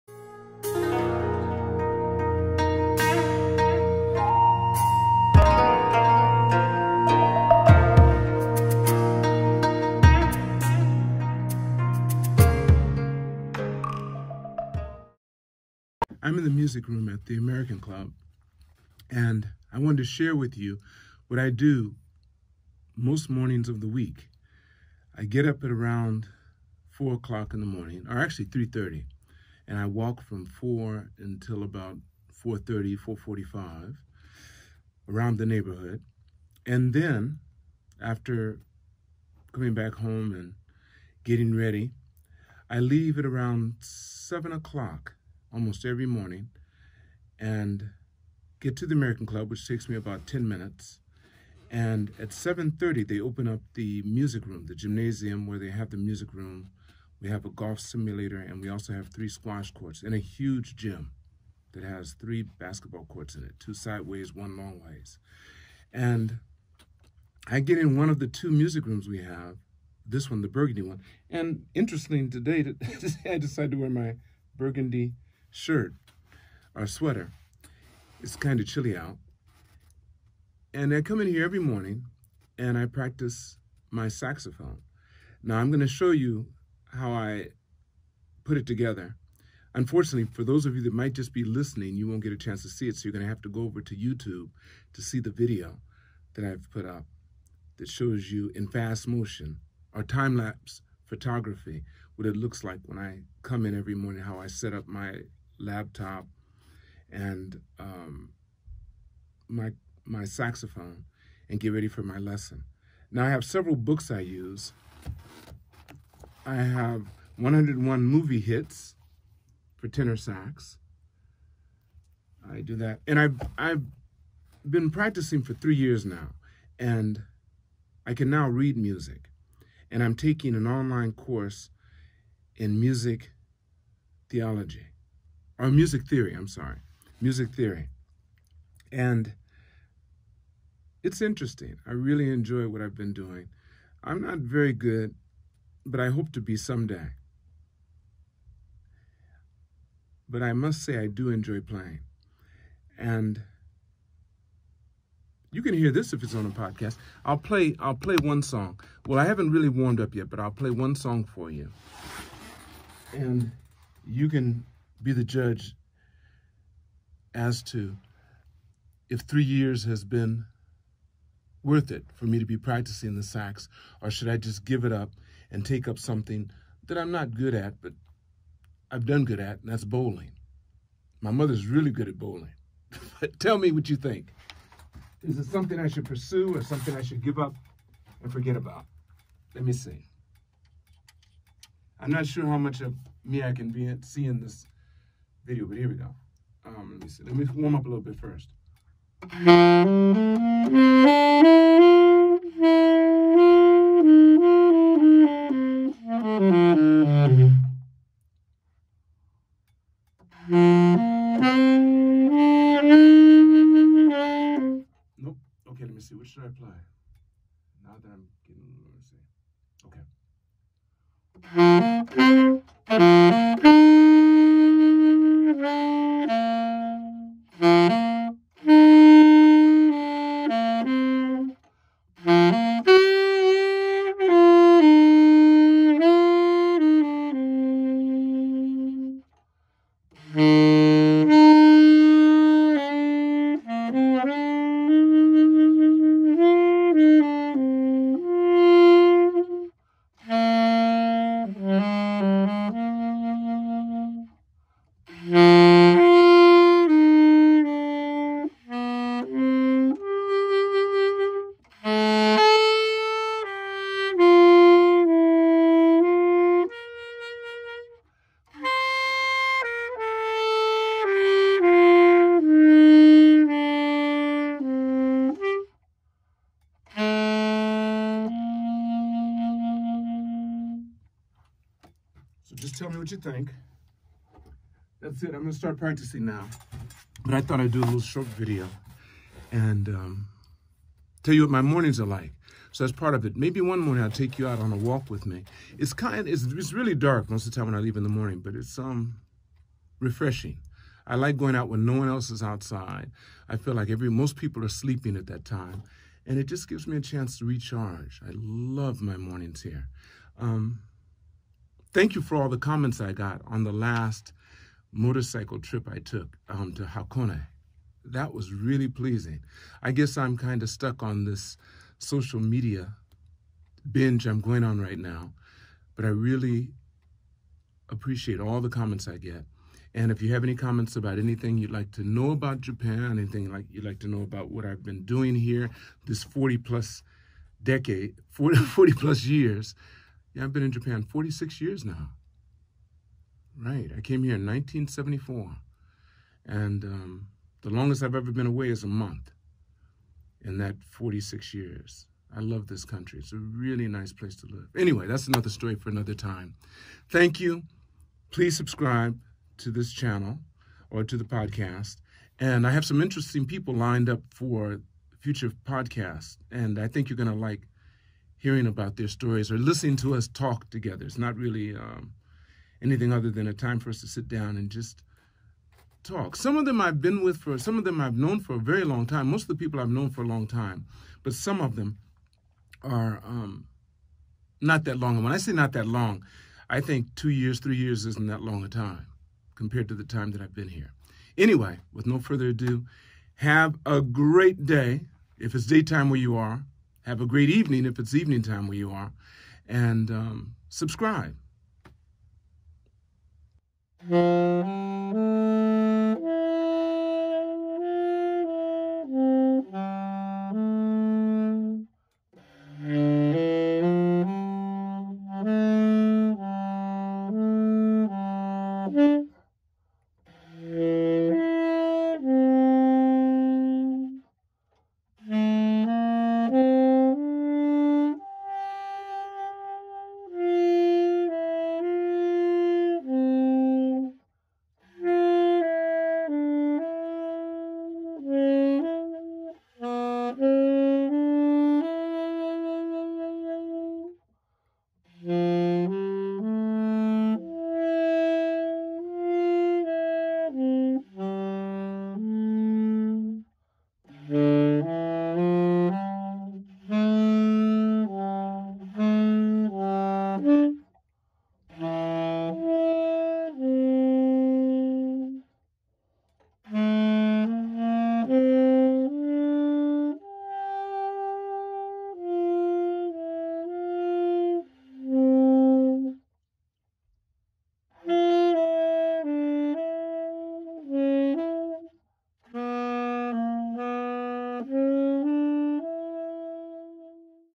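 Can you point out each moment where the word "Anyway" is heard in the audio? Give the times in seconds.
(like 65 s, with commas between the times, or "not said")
354 s, 391 s.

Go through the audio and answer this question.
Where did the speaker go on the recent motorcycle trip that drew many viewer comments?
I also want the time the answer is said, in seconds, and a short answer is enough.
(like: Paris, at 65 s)
Hakone, at 316 s.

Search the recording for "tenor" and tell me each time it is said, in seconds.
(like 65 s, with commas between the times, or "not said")
119 s.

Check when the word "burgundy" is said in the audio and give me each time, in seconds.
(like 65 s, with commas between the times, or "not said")
70 s, 74 s.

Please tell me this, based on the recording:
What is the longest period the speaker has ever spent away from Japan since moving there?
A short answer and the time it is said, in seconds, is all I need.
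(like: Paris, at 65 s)
A month, at 348 s.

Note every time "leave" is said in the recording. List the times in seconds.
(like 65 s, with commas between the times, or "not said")
42 s, 297 s.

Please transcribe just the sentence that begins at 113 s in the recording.
Now I have several books I use.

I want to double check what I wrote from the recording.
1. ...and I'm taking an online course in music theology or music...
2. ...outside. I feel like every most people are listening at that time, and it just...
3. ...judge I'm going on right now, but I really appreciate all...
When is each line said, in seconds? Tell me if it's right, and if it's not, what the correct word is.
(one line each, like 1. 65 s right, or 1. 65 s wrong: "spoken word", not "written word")
1. 129 s right
2. 302 s wrong: "sleeping", not "listening"
3. 323 s wrong: "binge", not "judge".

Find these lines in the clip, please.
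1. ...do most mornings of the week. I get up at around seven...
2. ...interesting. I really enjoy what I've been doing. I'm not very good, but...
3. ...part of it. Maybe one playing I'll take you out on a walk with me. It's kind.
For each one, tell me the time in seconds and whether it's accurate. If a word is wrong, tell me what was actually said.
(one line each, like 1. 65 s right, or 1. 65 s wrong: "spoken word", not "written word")
1. 21 s wrong: "four", not "seven"
2. 141 s right
3. 292 s wrong: "morning", not "playing".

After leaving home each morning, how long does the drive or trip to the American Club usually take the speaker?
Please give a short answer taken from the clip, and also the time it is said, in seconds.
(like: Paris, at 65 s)
About 10 minutes, at 49 s.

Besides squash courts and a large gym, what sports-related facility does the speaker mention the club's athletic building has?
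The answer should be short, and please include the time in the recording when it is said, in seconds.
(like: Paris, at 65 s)
A golf simulator, at 57 s.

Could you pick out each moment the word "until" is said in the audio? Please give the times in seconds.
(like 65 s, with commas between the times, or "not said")
31 s.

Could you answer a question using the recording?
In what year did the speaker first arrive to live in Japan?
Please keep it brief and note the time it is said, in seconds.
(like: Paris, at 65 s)
1974, at 344 s.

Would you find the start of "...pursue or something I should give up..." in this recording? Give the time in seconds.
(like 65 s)
186 s.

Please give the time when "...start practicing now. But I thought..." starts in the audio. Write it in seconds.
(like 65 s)
285 s.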